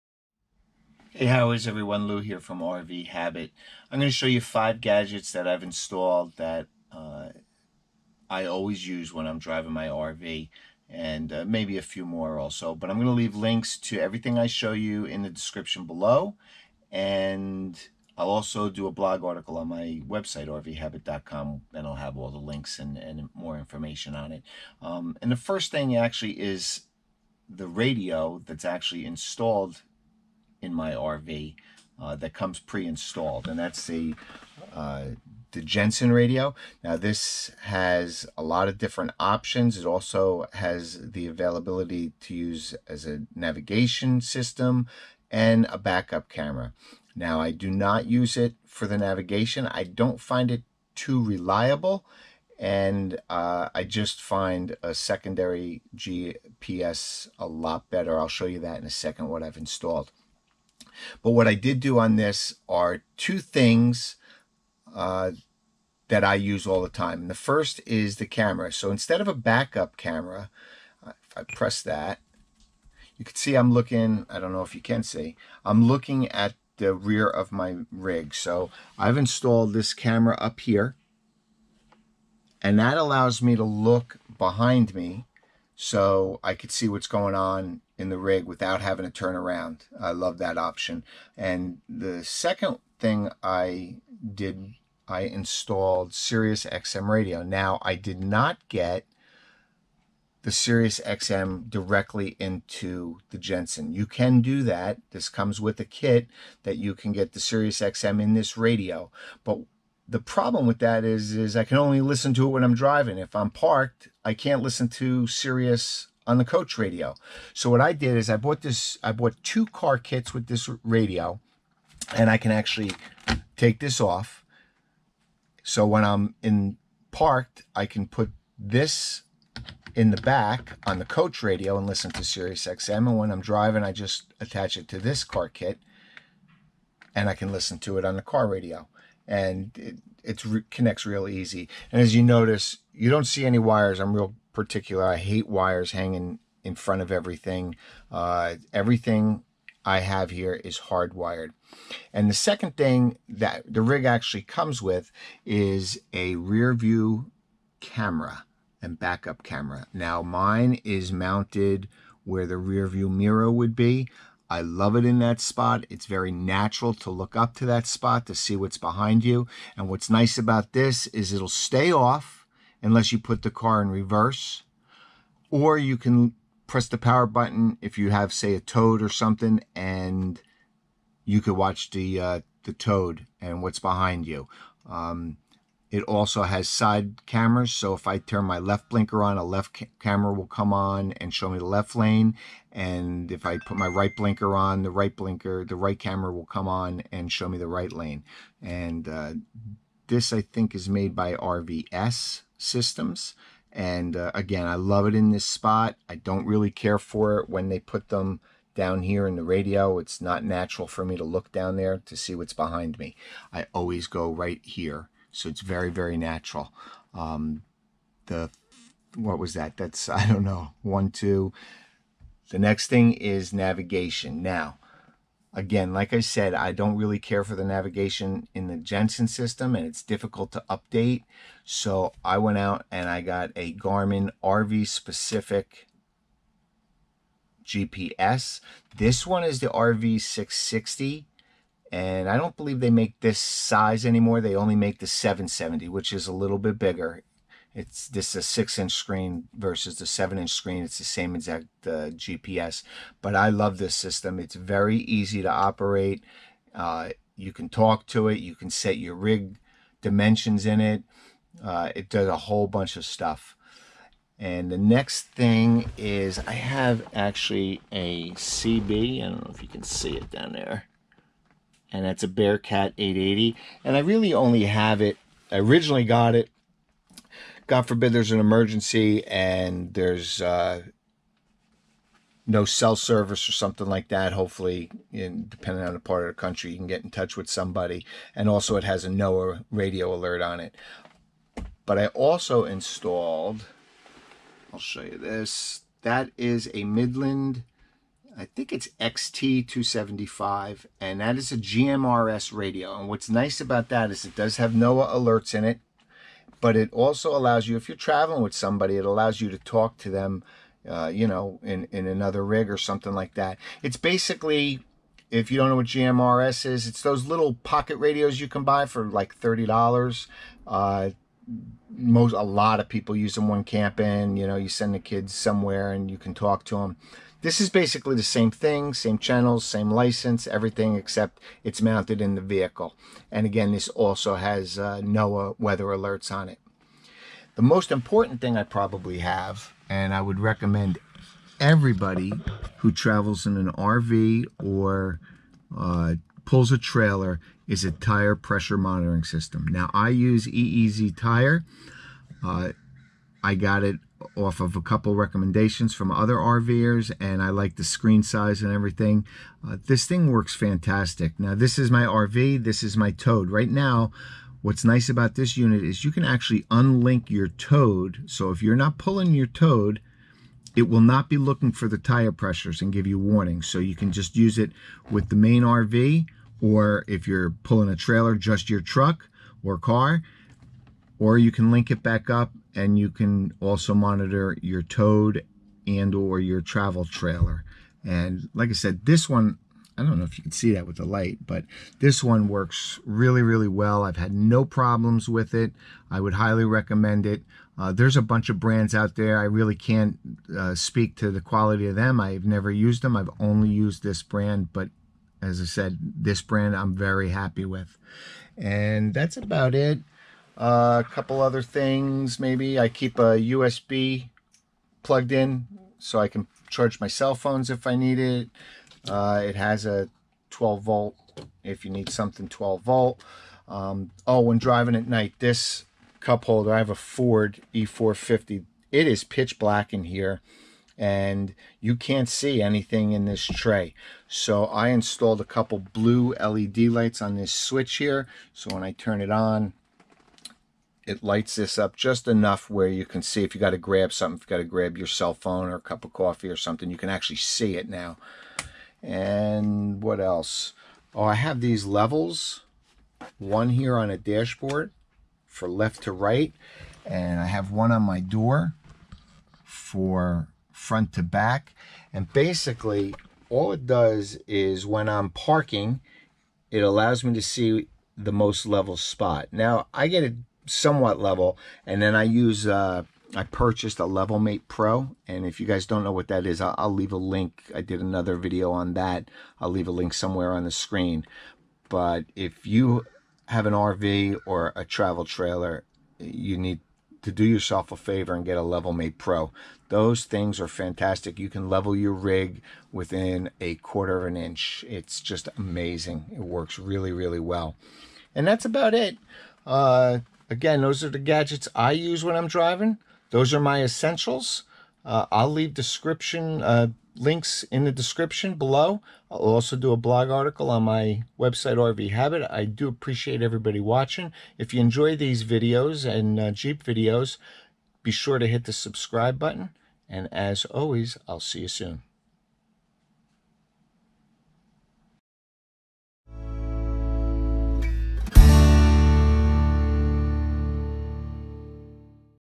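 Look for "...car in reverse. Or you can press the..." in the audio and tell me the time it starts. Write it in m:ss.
2:53.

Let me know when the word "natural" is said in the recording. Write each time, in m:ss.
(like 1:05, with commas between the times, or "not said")
2:46, 3:30, 3:36.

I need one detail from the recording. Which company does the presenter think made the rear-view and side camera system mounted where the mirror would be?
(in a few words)
RVS Systems.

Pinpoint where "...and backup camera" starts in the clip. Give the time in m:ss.
2:38.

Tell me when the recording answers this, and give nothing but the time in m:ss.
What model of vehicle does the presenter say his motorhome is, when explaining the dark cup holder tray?
7:06.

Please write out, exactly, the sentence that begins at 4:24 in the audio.
And the next thing is I have actually a CB.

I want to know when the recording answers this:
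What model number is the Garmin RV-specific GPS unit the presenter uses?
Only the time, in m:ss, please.
3:59.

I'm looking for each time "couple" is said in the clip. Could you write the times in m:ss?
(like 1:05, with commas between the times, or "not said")
5:54, 6:51, 7:15.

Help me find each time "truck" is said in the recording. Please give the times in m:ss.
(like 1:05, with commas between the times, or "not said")
6:18.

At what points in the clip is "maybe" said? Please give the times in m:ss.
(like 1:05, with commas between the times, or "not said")
0:11, 6:52.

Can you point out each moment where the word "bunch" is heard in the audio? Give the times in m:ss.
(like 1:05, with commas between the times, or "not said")
4:22, 6:38.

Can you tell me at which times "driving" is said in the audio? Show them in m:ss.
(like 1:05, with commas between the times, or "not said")
0:09, 1:52, 2:13, 7:04, 8:22.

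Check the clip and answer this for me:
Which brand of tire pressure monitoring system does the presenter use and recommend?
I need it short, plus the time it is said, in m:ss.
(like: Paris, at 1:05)
EEZ Tire, at 5:50.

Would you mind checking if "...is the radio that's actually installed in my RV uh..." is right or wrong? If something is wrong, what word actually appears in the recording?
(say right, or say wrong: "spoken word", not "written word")
right.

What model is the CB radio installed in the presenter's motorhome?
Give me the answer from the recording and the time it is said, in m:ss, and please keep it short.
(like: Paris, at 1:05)
Bearcat 880, at 4:32.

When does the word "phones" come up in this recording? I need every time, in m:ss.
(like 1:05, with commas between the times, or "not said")
6:57, 7:25.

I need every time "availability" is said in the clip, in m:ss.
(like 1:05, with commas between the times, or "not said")
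0:41.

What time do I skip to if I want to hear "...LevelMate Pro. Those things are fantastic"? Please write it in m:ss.
8:08.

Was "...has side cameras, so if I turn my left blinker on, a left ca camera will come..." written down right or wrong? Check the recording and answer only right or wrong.
right.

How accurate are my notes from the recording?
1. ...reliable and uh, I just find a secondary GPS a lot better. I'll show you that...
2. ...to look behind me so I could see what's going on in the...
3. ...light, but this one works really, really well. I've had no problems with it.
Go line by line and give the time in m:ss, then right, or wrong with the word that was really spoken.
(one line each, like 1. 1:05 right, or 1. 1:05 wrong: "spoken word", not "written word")
1. 0:51 right
2. 1:23 right
3. 6:31 right.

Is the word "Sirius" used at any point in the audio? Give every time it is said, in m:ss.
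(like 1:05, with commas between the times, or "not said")
1:36, 1:40, 1:47, 1:55, 2:12.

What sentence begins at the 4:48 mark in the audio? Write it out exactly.
And also, it has a NOAA radio alert on it.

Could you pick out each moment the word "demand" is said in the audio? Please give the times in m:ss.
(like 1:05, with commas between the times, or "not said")
not said.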